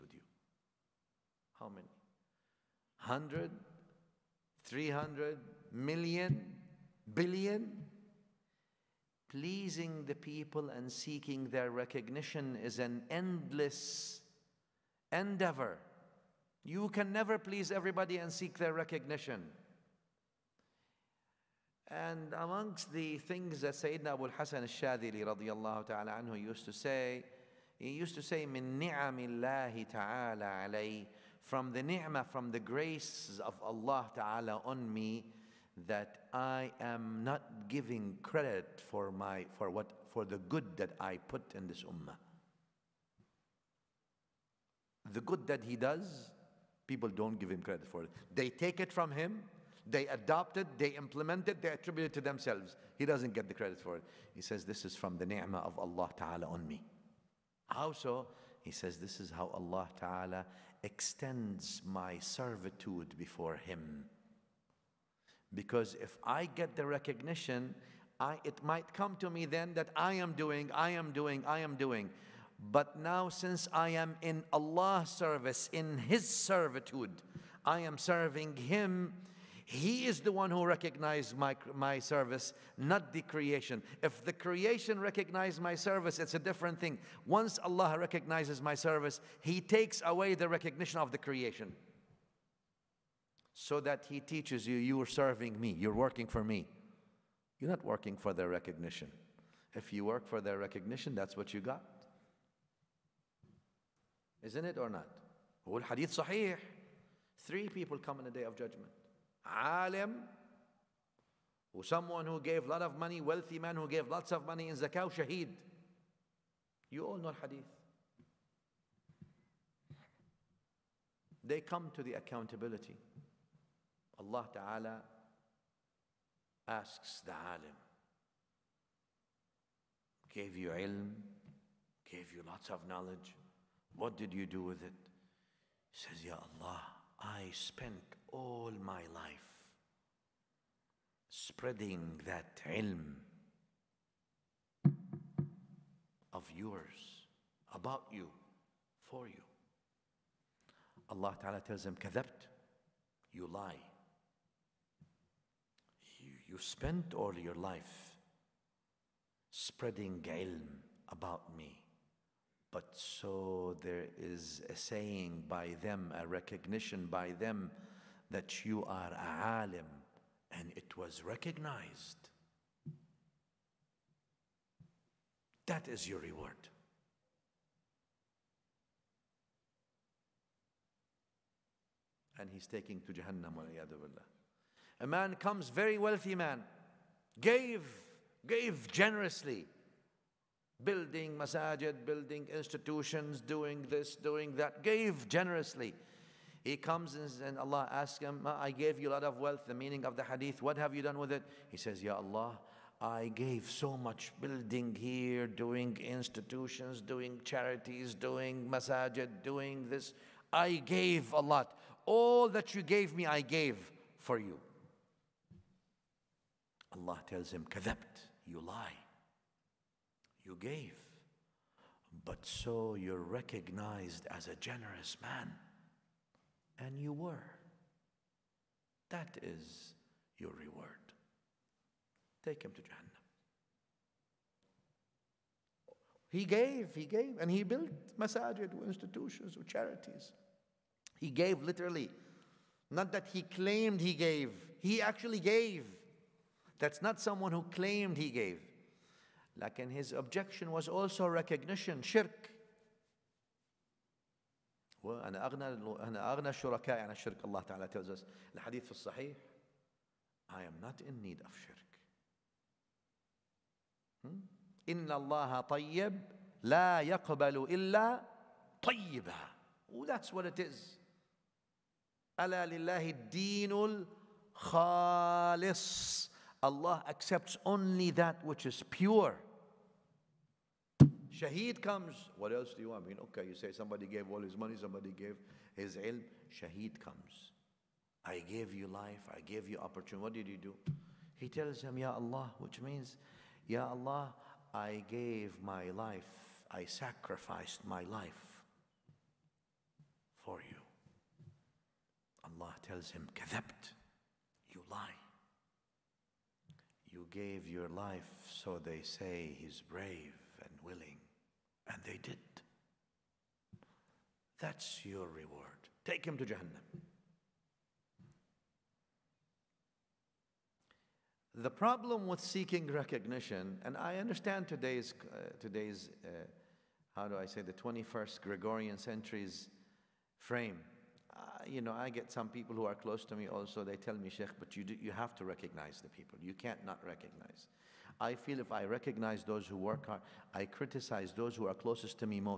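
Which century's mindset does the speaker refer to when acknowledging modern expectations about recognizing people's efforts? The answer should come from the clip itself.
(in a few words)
21st Gregorian century.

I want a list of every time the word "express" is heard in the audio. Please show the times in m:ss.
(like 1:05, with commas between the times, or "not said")
not said.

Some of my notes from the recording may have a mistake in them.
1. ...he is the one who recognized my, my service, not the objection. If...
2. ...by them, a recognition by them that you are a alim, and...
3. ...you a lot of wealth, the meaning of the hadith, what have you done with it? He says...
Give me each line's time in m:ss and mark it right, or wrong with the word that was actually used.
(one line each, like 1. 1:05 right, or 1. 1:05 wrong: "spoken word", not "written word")
1. 1:19 wrong: "creation", not "objection"
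2. 2:45 right
3. 3:18 right.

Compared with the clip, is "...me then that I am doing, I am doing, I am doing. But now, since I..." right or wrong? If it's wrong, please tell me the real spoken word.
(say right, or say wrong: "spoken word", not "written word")
right.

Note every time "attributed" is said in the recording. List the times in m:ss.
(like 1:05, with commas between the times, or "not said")
0:51.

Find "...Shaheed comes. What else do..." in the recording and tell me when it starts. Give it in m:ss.
4:41.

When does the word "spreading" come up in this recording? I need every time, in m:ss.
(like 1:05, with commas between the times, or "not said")
2:21, 2:39.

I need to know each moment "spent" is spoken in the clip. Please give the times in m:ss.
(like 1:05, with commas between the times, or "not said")
2:17, 2:36.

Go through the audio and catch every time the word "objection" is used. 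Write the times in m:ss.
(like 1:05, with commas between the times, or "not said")
4:10.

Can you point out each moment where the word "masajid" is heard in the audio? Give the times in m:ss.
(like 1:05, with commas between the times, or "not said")
3:11, 3:28, 3:58.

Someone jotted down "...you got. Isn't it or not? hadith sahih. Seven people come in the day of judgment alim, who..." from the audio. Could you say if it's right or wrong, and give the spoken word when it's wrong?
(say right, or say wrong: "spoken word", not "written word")
wrong: "Three", not "Seven".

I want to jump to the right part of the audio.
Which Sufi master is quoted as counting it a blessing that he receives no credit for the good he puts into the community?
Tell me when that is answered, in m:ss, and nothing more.
0:24.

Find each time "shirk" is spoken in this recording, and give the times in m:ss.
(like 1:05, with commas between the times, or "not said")
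4:12, 4:21.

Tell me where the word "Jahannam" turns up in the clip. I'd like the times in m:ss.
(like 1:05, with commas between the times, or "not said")
3:03, 3:52, 5:16.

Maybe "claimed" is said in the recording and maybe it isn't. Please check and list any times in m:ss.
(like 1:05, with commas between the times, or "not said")
4:03, 4:07.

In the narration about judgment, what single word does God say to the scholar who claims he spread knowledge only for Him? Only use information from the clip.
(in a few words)
Kadhabt.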